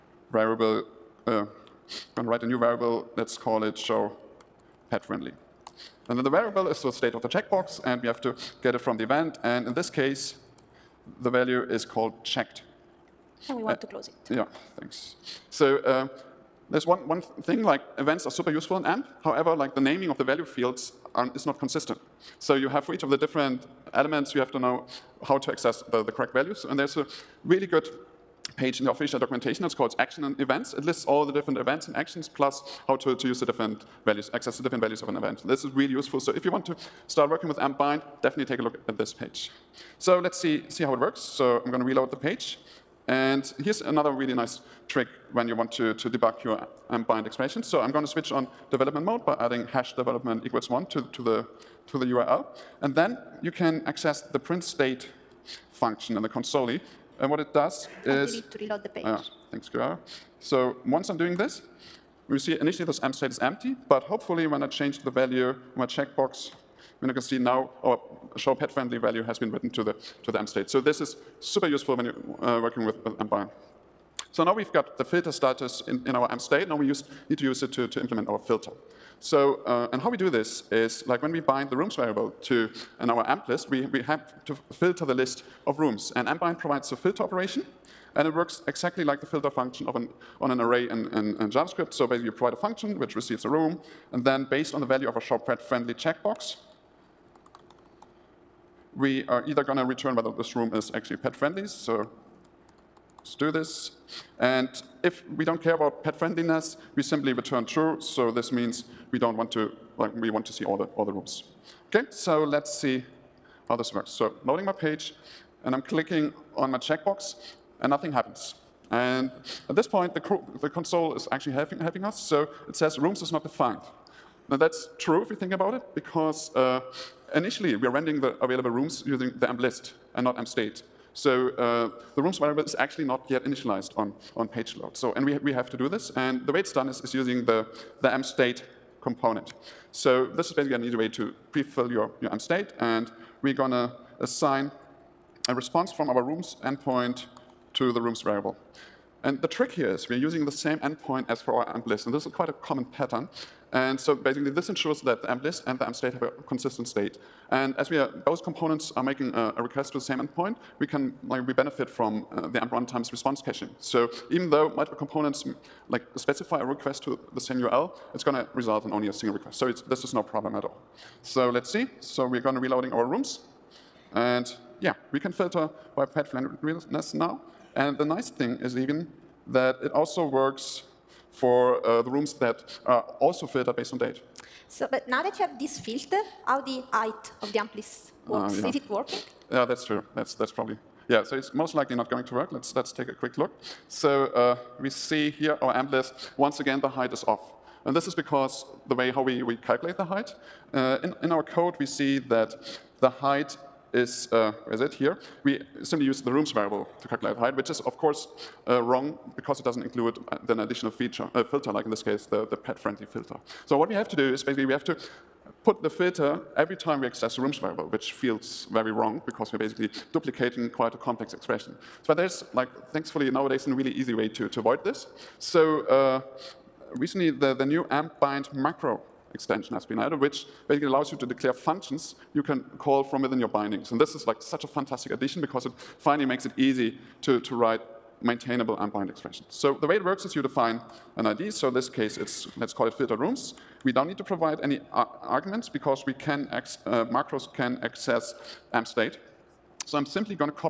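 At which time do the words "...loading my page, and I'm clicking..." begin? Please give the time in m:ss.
1:54.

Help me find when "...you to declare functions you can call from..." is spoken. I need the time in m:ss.
3:51.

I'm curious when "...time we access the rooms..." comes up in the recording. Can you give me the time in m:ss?
3:36.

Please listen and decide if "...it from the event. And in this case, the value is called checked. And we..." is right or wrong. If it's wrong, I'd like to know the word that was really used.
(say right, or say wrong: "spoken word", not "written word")
right.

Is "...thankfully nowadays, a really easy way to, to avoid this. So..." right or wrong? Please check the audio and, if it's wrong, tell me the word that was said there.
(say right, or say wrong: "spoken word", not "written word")
right.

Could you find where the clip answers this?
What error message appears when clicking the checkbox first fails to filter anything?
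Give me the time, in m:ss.
2:02.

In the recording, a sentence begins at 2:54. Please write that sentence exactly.
And yeah, we can filter by pet friendliness now.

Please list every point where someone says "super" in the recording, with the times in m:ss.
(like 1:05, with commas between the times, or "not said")
0:18, 1:11.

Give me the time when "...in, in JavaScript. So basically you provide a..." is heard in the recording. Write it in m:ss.
1:31.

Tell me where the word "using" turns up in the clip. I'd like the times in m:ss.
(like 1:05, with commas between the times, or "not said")
2:09, 2:17, 2:30.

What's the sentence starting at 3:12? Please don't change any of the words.
Let's, let's take a quick look.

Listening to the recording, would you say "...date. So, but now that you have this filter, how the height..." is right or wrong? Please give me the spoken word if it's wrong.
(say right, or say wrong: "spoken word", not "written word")
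right.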